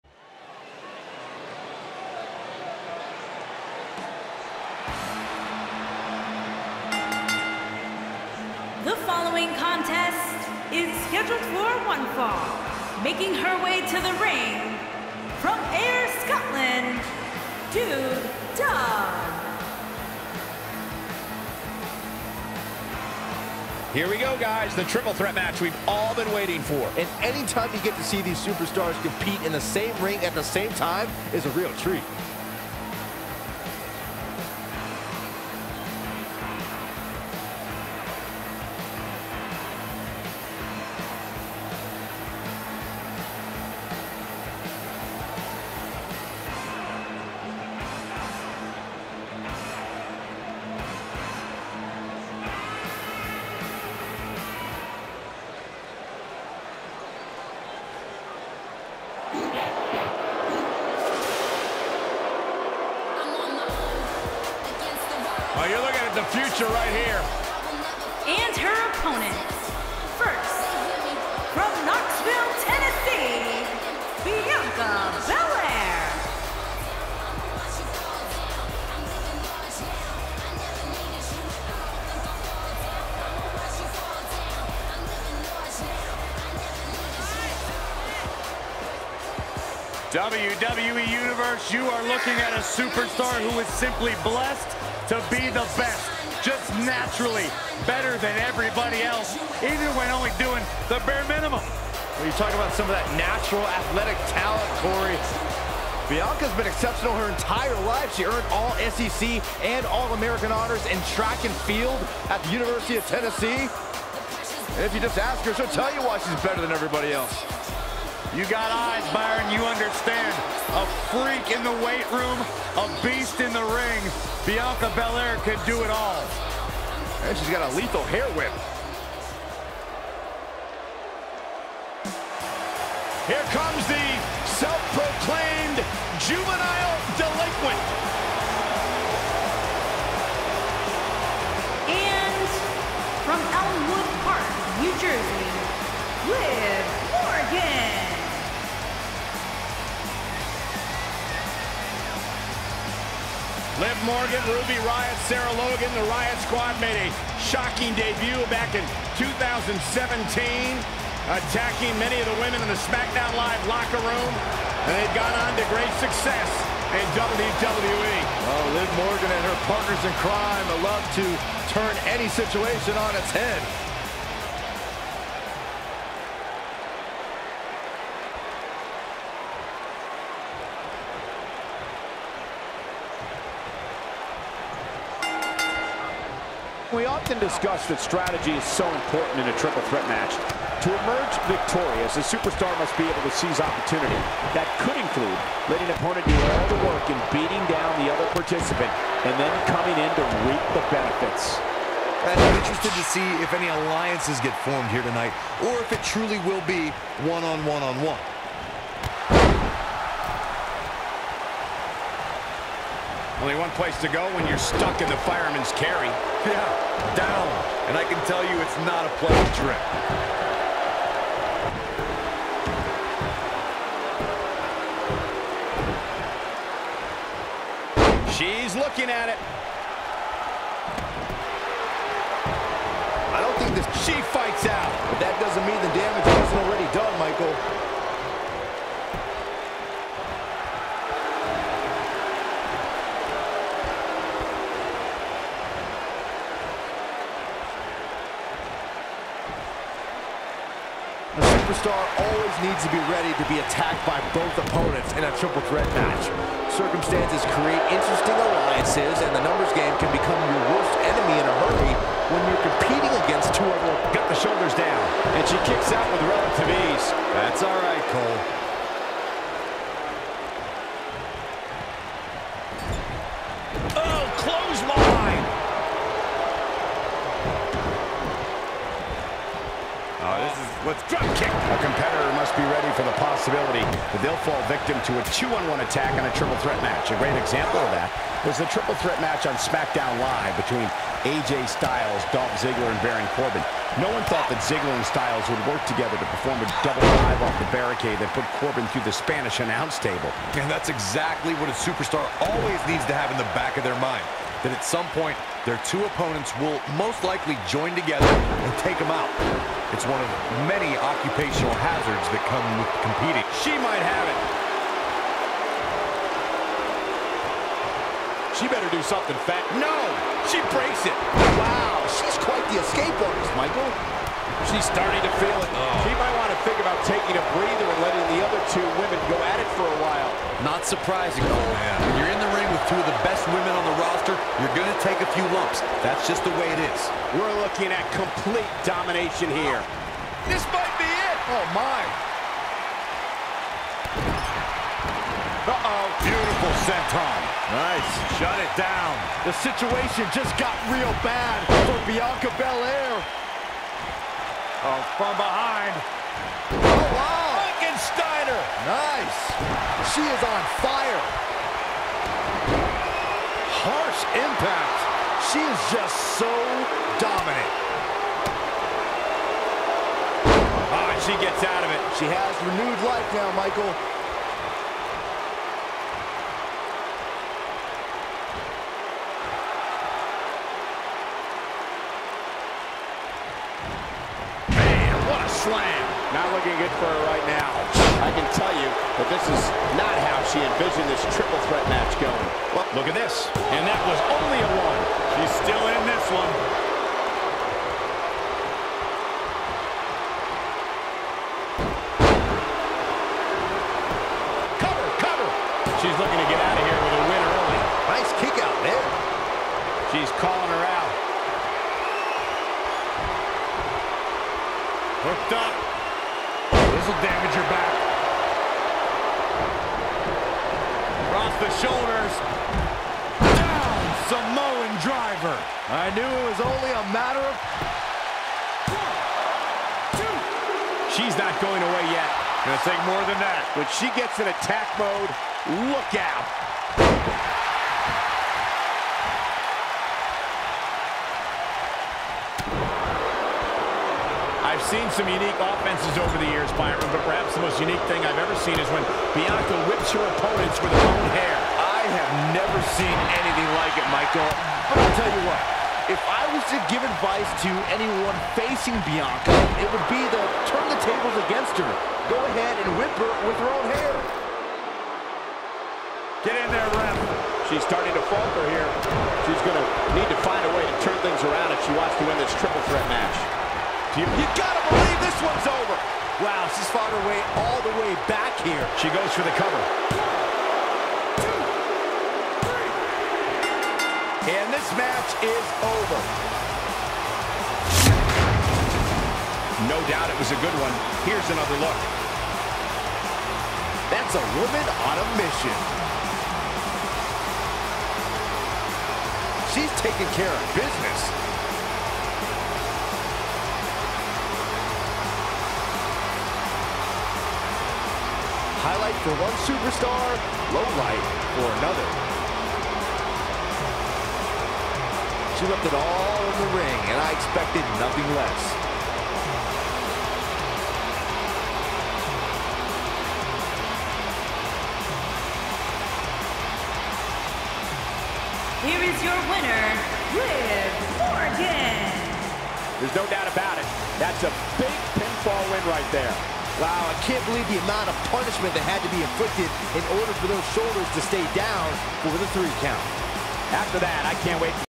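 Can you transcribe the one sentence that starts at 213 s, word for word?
Only one place to go when you're stuck in the fireman's carry.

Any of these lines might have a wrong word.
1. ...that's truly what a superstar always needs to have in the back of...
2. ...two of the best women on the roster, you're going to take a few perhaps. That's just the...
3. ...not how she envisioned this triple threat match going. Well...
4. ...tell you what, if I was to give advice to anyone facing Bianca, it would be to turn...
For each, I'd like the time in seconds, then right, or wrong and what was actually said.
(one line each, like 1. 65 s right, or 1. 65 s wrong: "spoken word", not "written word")
1. 300 s wrong: "exactly", not "truly"
2. 332 s wrong: "lumps", not "perhaps"
3. 389 s right
4. 455 s right.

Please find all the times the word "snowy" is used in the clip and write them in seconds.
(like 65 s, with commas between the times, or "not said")
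not said.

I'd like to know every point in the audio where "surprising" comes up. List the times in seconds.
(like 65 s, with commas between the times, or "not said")
330 s.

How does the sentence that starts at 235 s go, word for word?
But that doesn't mean the damage wasn't already done.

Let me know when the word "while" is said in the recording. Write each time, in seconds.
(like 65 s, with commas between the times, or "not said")
330 s.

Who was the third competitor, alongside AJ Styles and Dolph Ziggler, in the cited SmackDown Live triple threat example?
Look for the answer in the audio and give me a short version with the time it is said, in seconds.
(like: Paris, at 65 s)
Baron Corbin, at 293 s.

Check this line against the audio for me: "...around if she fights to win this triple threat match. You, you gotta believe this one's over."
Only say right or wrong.
wrong.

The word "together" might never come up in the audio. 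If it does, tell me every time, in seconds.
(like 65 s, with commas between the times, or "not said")
295 s, 307 s.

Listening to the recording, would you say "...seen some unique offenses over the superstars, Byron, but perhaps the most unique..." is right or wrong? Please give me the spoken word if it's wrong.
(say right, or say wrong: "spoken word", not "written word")
wrong: "years", not "superstars".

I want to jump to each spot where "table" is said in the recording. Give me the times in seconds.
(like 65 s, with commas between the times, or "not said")
300 s, 460 s.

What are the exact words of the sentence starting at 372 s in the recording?
She has renewed life now, Michael.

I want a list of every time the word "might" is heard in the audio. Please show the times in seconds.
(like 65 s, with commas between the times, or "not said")
313 s, 326 s, 340 s.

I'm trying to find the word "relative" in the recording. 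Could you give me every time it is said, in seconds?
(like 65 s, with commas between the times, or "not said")
266 s.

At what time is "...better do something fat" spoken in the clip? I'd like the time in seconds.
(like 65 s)
318 s.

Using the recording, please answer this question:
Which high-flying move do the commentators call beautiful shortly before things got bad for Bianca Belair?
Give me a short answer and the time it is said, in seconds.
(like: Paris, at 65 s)
Senton, at 346 s.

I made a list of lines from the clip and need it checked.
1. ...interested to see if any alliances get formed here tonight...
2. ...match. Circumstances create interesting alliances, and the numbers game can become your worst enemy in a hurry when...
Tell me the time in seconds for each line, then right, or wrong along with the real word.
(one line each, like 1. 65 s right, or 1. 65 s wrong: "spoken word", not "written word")
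1. 202 s right
2. 255 s right.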